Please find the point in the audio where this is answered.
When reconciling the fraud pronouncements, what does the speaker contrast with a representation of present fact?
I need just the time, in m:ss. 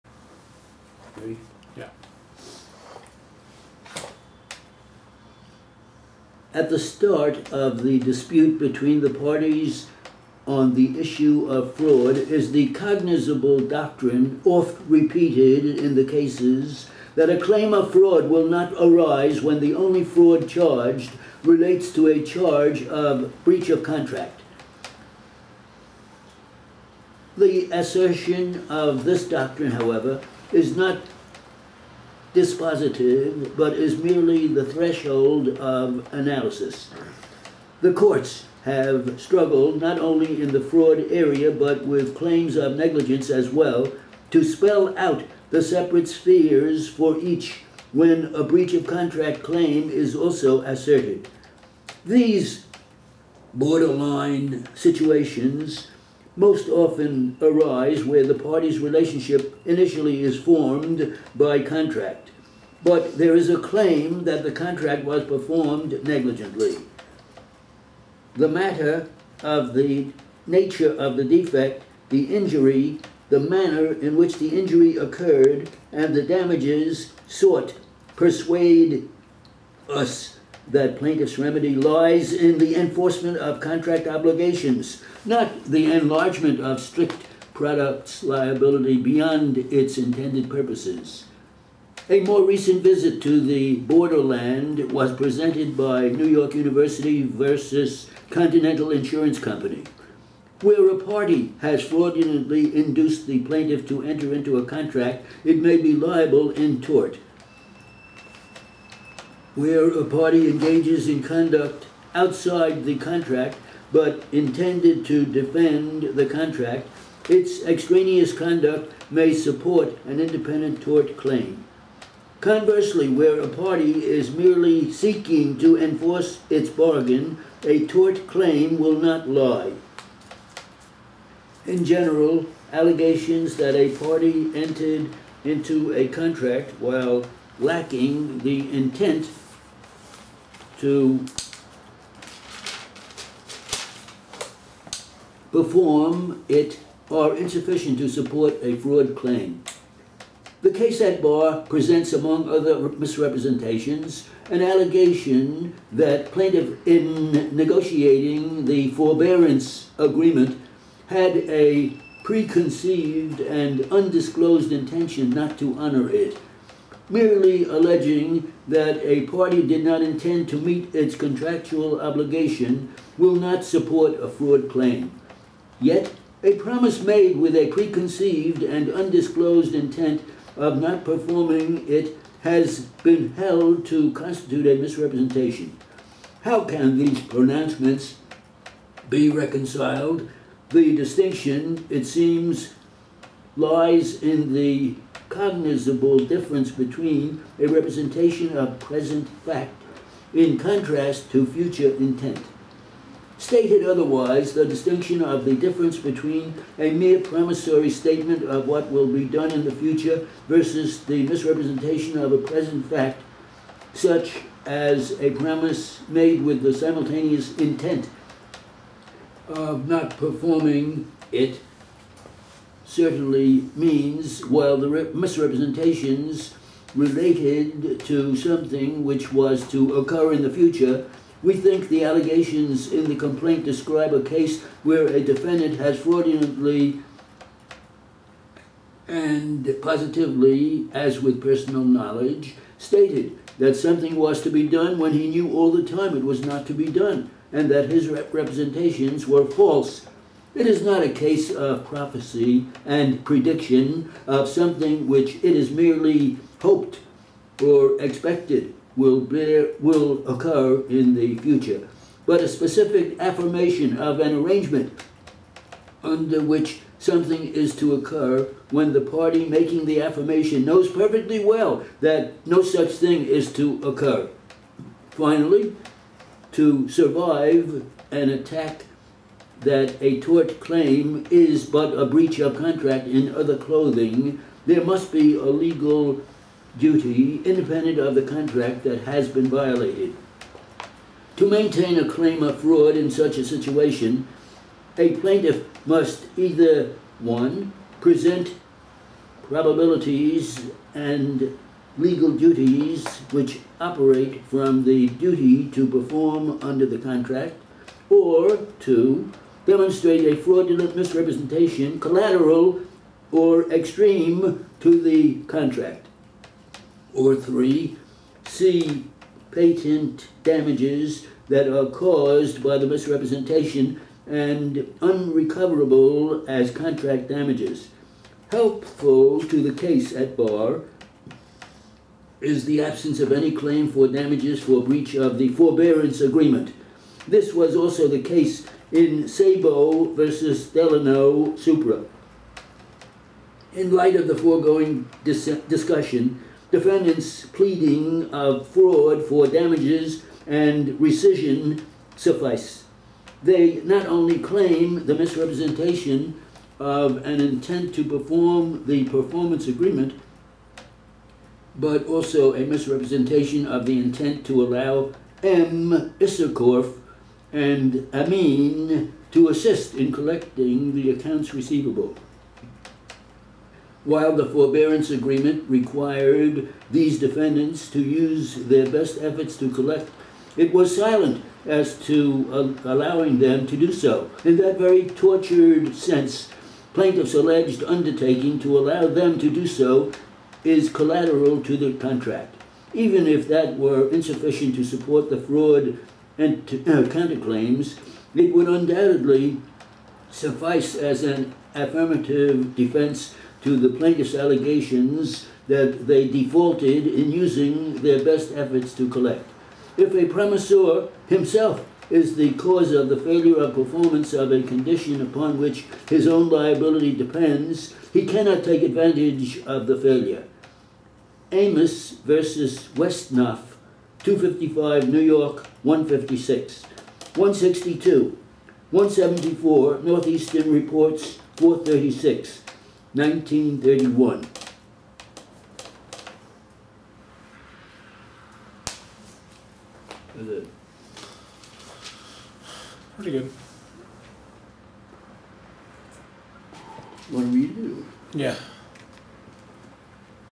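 3:21.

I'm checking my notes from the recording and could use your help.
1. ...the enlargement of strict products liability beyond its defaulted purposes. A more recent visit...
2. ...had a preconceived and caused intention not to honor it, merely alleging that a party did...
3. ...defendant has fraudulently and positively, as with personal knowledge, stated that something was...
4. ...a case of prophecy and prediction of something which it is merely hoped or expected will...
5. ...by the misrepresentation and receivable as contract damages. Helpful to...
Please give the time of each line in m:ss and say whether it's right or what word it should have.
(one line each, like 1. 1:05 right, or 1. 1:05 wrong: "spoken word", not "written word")
1. 1:25 wrong: "intended", not "defaulted"
2. 2:41 wrong: "undisclosed", not "caused"
3. 3:55 right
4. 4:11 right
5. 5:22 wrong: "unrecoverable", not "receivable".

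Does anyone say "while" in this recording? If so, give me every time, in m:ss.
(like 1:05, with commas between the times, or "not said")
2:16, 3:44, 6:14.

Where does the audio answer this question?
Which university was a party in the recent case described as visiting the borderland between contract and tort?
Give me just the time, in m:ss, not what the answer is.
1:36.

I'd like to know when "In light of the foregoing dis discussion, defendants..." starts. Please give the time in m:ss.
5:43.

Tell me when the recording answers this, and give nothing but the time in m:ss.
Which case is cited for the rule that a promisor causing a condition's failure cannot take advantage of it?
7:01.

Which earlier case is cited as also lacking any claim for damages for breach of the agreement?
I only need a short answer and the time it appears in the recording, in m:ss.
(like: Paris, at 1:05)
Sabo versus Delman, at 5:39.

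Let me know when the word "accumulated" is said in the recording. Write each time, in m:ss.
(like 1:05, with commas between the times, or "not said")
not said.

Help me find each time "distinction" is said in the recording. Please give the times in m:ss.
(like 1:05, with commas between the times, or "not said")
3:10, 3:24.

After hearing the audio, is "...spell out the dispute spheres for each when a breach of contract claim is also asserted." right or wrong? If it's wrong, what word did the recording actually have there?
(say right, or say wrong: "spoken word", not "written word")
wrong: "separate", not "dispute".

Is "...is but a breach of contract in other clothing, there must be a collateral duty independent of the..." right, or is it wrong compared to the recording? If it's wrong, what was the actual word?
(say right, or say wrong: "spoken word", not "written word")
wrong: "legal", not "collateral".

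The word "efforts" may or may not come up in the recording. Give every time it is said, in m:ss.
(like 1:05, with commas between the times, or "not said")
6:19, 6:48.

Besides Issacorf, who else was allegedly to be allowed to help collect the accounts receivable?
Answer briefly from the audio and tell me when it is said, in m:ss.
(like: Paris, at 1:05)
Amin, at 6:08.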